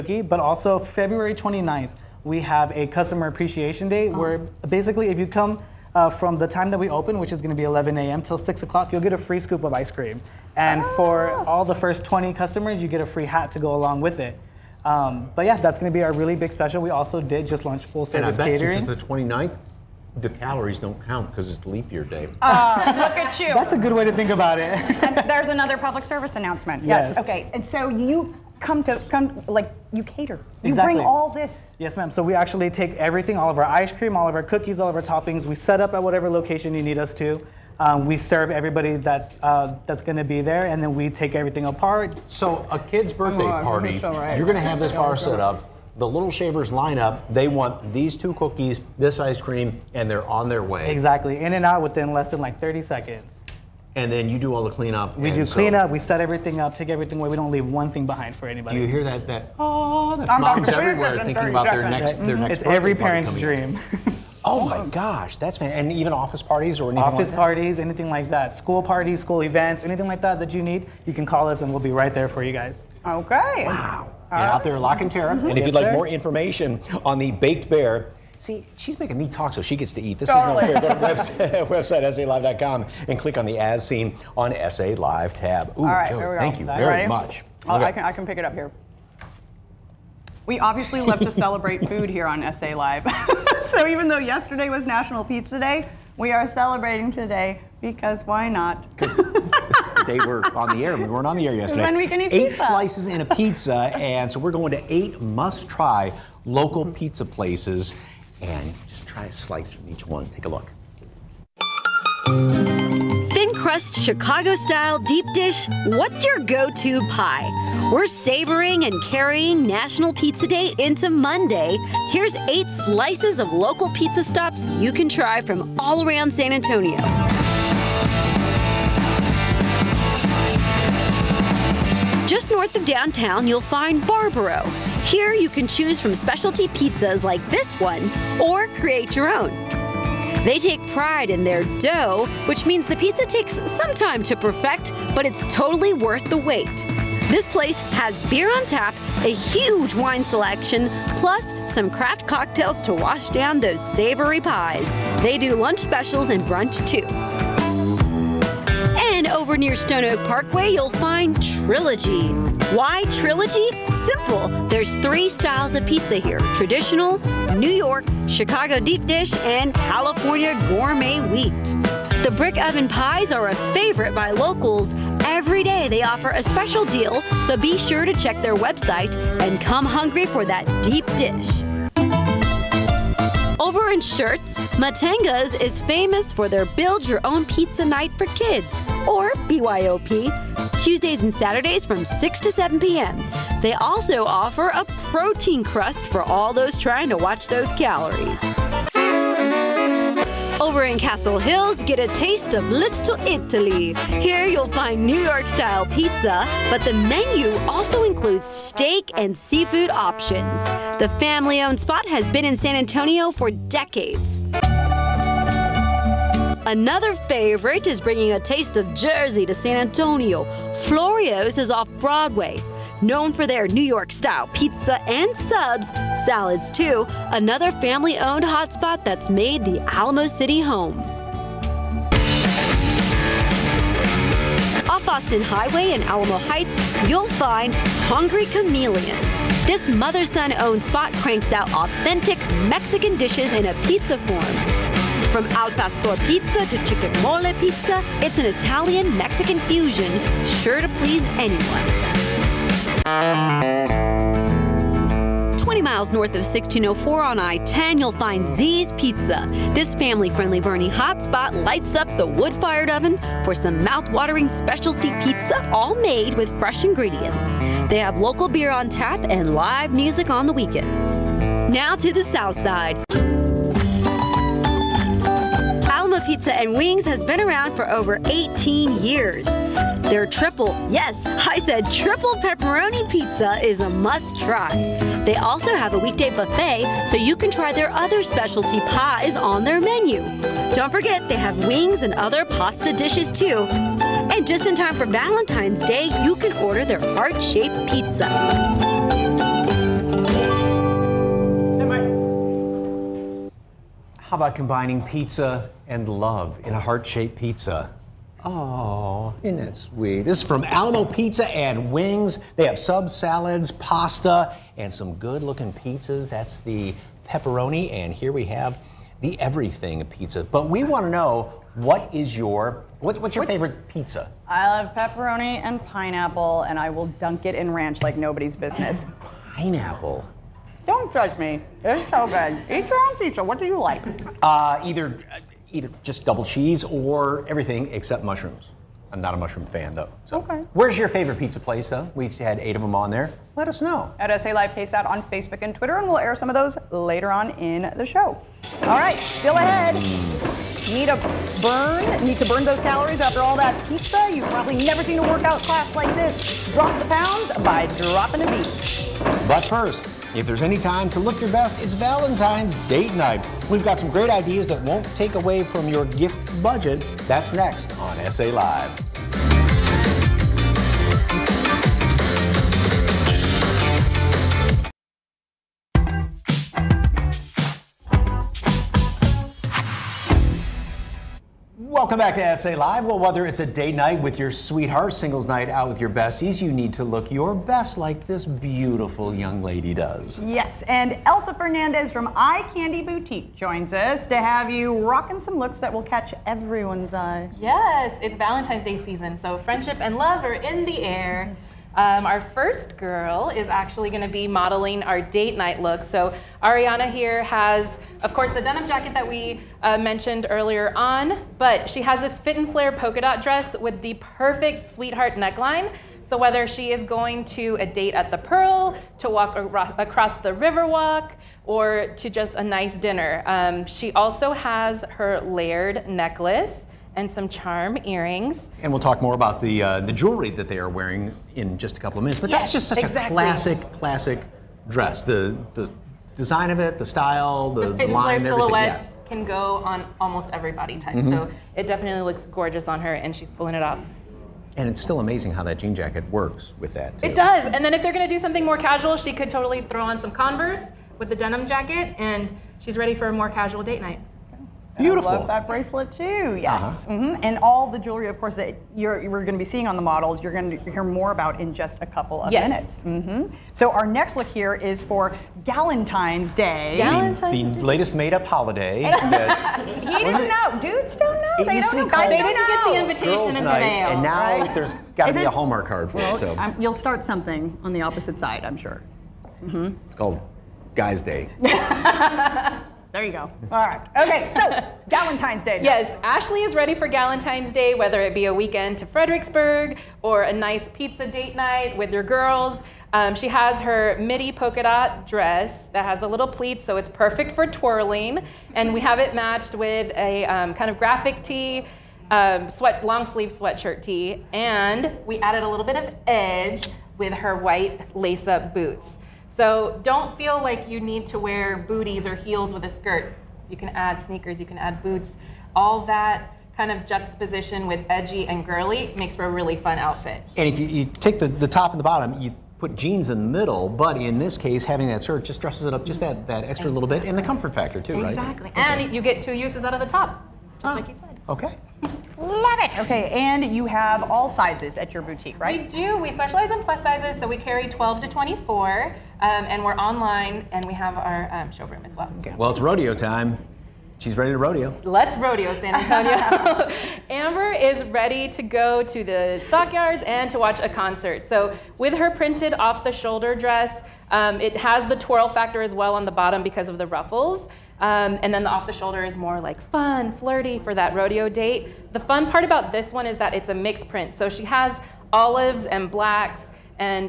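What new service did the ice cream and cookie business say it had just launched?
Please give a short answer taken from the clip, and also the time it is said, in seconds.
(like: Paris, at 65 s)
full service catering, at 17 s.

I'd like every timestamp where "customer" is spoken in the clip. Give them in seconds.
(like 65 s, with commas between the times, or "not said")
2 s, 12 s.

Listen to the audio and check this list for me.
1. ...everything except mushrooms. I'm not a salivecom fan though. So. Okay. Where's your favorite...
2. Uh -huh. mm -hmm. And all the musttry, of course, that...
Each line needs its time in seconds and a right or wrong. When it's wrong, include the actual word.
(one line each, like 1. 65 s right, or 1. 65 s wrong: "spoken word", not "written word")
1. 337 s wrong: "mushroom", not "salivecom"
2. 456 s wrong: "jewelry", not "musttry".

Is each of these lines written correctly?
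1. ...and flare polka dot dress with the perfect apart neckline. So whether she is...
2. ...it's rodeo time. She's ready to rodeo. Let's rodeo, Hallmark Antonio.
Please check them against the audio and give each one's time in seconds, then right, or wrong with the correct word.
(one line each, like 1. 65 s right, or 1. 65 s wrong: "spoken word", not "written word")
1. 412 s wrong: "sweetheart", not "apart"
2. 542 s wrong: "San", not "Hallmark".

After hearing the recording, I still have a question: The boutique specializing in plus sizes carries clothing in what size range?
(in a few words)
12 to 24.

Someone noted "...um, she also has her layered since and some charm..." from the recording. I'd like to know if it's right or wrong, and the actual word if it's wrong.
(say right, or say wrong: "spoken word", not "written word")
wrong: "necklace", not "since".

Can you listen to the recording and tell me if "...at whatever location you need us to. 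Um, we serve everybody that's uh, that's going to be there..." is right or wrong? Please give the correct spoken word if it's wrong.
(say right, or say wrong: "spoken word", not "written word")
right.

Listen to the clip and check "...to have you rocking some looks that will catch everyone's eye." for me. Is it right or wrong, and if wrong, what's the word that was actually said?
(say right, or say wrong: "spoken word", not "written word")
right.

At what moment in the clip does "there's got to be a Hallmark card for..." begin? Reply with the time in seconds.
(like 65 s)
474 s.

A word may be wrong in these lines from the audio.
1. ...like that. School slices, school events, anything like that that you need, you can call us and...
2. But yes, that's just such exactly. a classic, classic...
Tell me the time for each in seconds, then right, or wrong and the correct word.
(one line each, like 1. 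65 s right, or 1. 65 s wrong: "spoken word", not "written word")
1. 68 s wrong: "parties", not "slices"
2. 432 s right.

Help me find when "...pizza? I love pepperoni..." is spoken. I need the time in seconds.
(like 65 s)
323 s.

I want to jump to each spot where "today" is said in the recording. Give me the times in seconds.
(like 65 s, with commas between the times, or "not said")
97 s.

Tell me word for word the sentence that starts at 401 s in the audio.
Um, our first girl is actually going to be modeling our date night look.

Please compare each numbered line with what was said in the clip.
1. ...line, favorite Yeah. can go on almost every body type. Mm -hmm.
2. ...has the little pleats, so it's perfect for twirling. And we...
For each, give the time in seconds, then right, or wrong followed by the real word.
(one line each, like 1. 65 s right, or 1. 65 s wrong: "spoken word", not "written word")
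1. 438 s wrong: "silhouette", not "favorite"
2. 496 s right.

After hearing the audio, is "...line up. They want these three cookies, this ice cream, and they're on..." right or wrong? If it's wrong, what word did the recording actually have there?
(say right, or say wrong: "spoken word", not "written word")
wrong: "two", not "three".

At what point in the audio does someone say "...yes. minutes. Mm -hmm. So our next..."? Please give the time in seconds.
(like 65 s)
462 s.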